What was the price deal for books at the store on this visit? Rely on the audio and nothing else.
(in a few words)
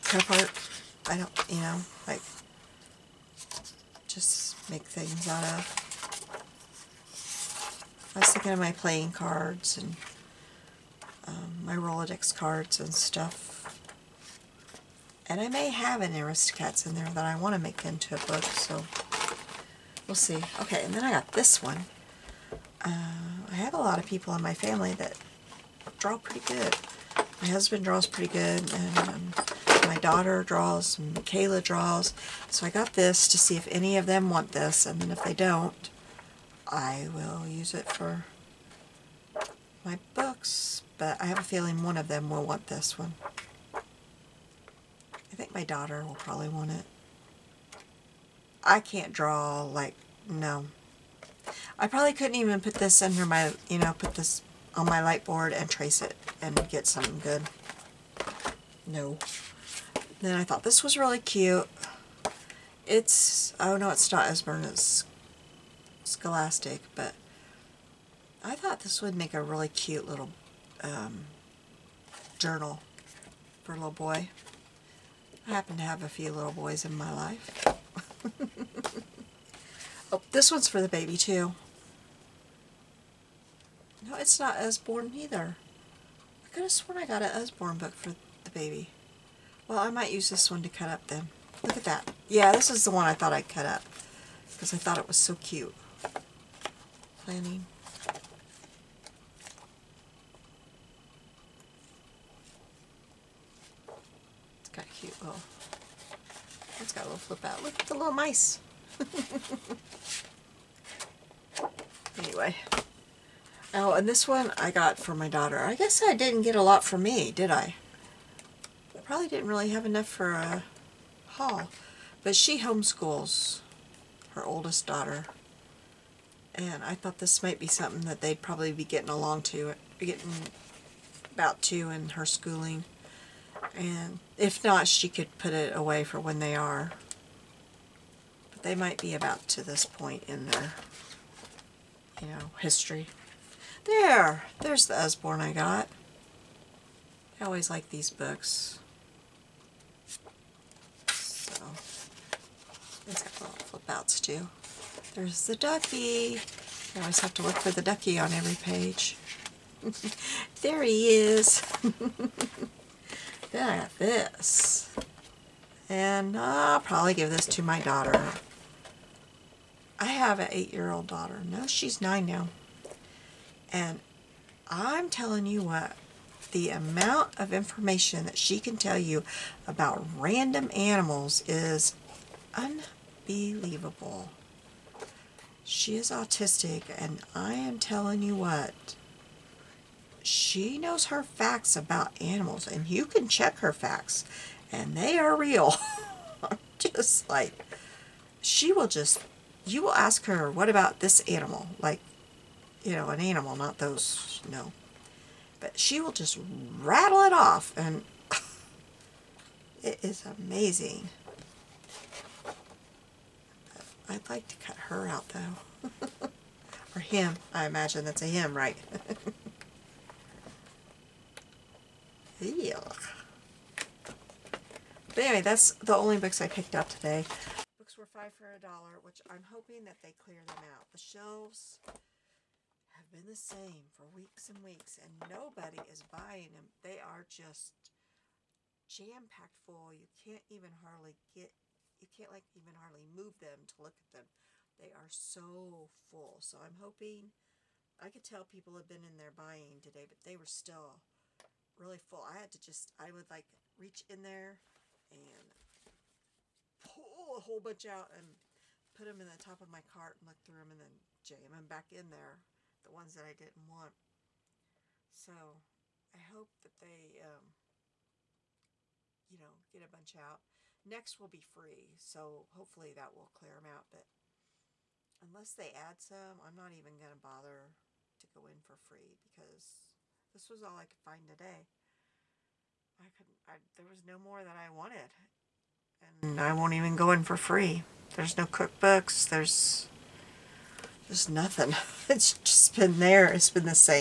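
5 for $1.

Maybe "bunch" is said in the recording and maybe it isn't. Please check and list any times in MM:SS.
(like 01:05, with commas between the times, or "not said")
04:17, 04:29.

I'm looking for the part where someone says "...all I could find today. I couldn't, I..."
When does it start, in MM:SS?
04:40.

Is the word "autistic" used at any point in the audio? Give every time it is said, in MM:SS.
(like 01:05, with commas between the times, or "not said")
03:06.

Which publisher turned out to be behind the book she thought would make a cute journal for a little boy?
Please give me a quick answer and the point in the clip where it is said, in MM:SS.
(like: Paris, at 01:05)
Scholastic, at 01:06.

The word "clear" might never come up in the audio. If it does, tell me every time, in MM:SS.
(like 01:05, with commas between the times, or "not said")
03:50, 04:33.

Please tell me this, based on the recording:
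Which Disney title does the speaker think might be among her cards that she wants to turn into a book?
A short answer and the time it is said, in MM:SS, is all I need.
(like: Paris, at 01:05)
Aristocats, at 00:16.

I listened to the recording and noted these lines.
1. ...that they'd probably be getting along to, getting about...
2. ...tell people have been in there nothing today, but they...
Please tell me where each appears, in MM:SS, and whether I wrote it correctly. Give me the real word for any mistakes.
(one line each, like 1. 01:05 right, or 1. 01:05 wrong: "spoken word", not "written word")
1. 02:08 right
2. 04:08 wrong: "buying", not "nothing".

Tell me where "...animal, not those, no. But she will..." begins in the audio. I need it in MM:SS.
03:23.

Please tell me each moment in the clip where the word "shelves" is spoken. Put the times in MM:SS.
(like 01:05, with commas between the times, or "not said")
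03:50.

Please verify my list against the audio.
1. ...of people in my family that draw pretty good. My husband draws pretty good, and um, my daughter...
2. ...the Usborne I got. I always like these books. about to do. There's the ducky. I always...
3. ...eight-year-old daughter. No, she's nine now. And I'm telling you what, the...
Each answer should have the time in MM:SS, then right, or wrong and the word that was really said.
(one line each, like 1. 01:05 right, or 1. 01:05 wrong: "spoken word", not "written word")
1. 00:23 right
2. 02:24 right
3. 02:50 right.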